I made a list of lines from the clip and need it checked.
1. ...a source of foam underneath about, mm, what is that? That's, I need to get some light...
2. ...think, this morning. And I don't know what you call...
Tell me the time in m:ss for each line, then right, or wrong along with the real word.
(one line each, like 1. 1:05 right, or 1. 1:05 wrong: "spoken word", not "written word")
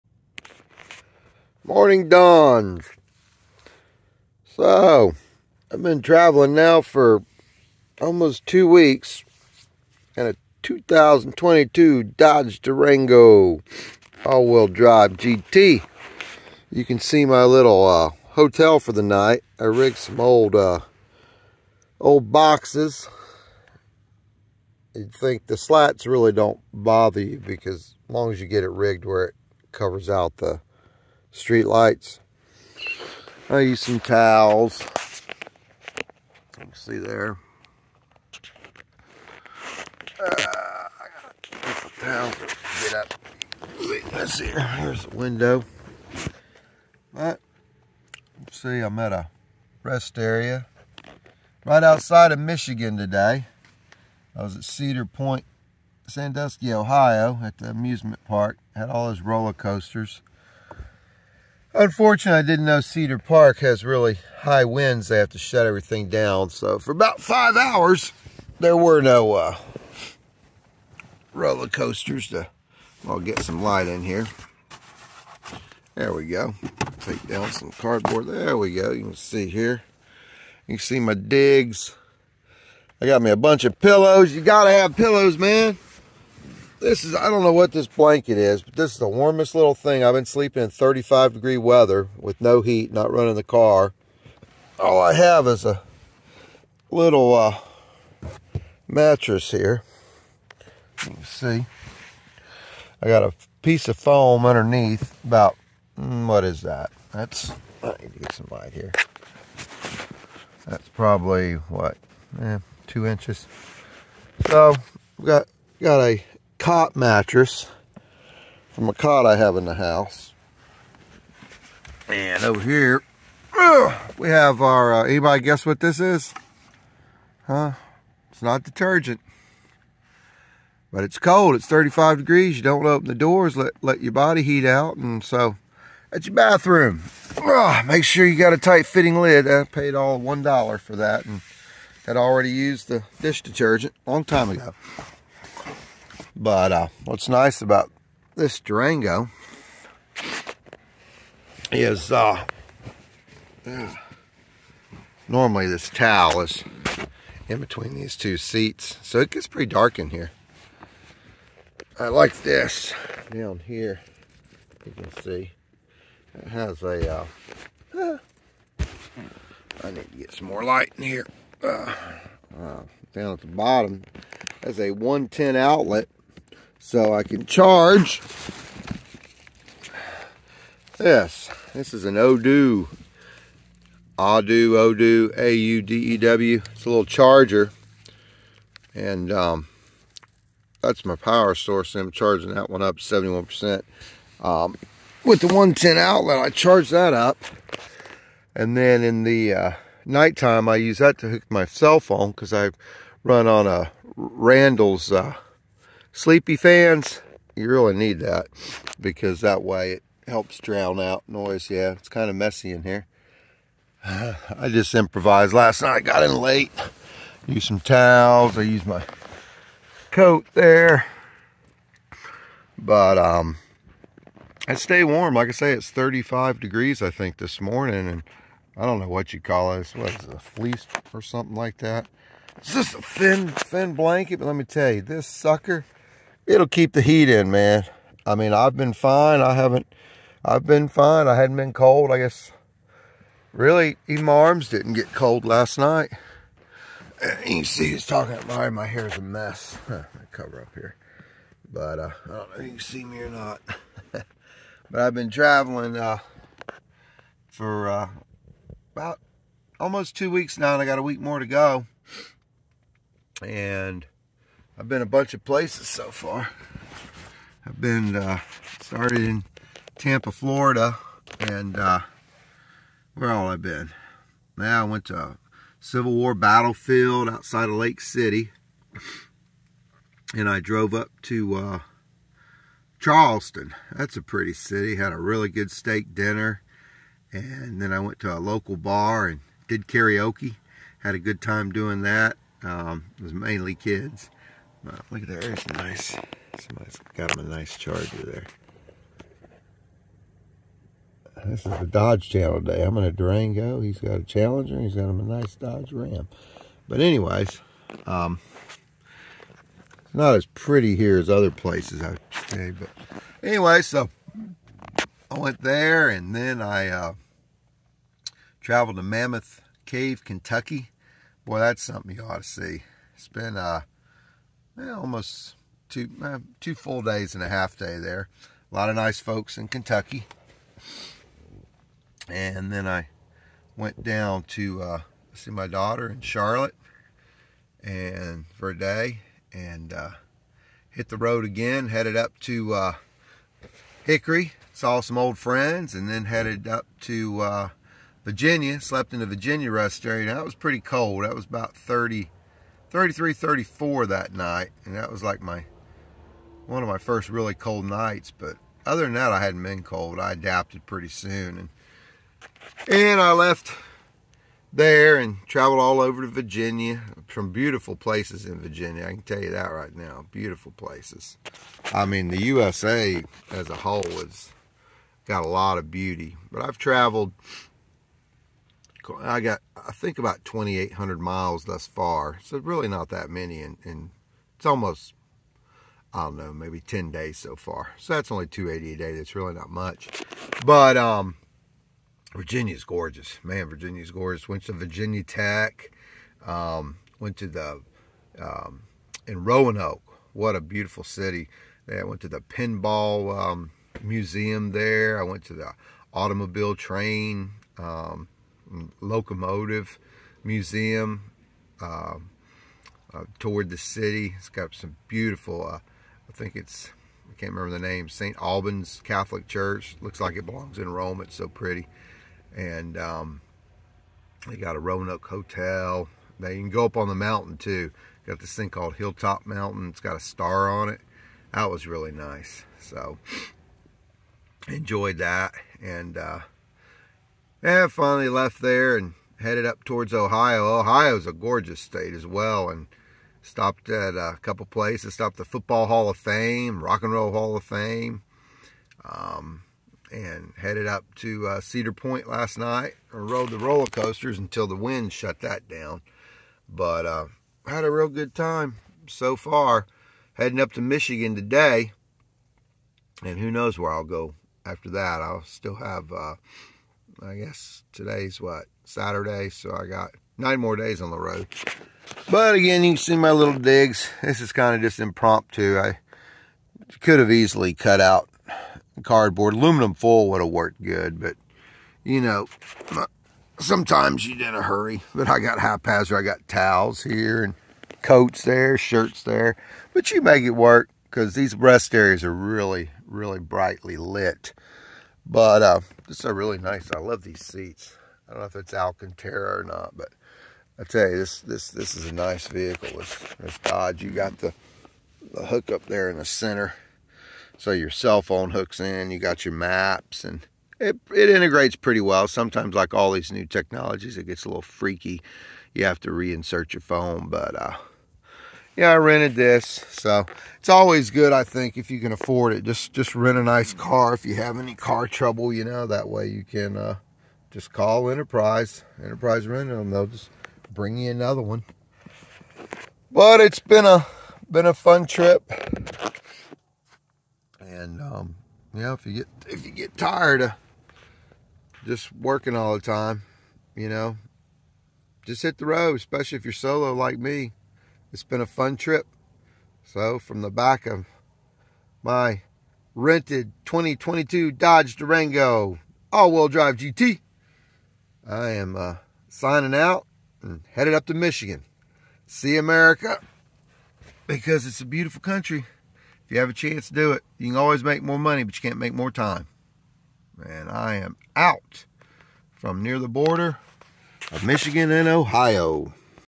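1. 1:43 wrong: "piece", not "source"
2. 3:47 right.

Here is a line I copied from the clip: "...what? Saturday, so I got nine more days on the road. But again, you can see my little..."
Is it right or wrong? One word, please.
right.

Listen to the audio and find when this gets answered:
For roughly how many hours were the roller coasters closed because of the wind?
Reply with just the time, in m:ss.
1:07.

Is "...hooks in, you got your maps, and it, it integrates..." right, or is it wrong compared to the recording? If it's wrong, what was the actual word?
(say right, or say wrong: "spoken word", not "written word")
right.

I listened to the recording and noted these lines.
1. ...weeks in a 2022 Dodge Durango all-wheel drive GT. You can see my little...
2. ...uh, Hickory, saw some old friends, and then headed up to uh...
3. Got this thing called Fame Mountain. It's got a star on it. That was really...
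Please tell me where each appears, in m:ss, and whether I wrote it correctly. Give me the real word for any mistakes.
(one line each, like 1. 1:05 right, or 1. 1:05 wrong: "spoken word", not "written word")
1. 0:08 right
2. 5:42 right
3. 7:08 wrong: "Hilltop", not "Fame".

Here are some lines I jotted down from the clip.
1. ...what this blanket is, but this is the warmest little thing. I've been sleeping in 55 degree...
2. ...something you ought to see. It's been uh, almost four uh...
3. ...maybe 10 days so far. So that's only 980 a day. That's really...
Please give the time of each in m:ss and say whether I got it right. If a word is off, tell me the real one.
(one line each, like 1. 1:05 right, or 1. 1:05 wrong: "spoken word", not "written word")
1. 1:27 wrong: "35", not "55"
2. 5:21 wrong: "two", not "four"
3. 6:26 wrong: "280", not "980".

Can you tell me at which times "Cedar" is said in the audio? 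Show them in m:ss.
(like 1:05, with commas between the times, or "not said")
0:54, 1:02, 7:31.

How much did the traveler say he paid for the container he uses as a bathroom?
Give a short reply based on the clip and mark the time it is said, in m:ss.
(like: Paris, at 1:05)
$1, at 2:20.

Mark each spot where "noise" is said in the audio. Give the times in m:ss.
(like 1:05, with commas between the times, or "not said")
3:31.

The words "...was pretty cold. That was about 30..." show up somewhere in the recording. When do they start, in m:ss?
5:50.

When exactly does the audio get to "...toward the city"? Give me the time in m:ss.
6:53.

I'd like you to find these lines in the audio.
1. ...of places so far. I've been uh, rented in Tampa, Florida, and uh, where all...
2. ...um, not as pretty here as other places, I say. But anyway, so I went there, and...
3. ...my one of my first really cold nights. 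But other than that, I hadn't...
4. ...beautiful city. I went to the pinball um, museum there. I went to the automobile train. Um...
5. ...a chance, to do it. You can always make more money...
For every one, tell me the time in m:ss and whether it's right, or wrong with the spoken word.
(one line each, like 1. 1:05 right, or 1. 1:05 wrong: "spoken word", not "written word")
1. 4:25 wrong: "started", not "rented"
2. 5:08 right
3. 5:55 right
4. 6:40 right
5. 9:26 right.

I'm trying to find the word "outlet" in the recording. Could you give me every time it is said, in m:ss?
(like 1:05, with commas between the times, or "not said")
2:55, 3:15.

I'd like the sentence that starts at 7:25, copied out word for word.
Stopped the Football Hall of Fame, Rock and Roll Hall of Fame.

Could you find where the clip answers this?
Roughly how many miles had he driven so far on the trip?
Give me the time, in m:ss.
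6:20.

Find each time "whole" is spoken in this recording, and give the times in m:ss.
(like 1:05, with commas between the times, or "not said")
6:13.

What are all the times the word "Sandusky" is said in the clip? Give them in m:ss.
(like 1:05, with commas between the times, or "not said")
0:56.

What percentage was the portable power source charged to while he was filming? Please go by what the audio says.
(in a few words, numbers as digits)
71%.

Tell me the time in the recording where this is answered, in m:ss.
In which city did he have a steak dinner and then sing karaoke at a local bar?
4:42.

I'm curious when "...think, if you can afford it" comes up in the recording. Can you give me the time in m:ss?
8:41.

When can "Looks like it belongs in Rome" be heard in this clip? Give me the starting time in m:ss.
7:00.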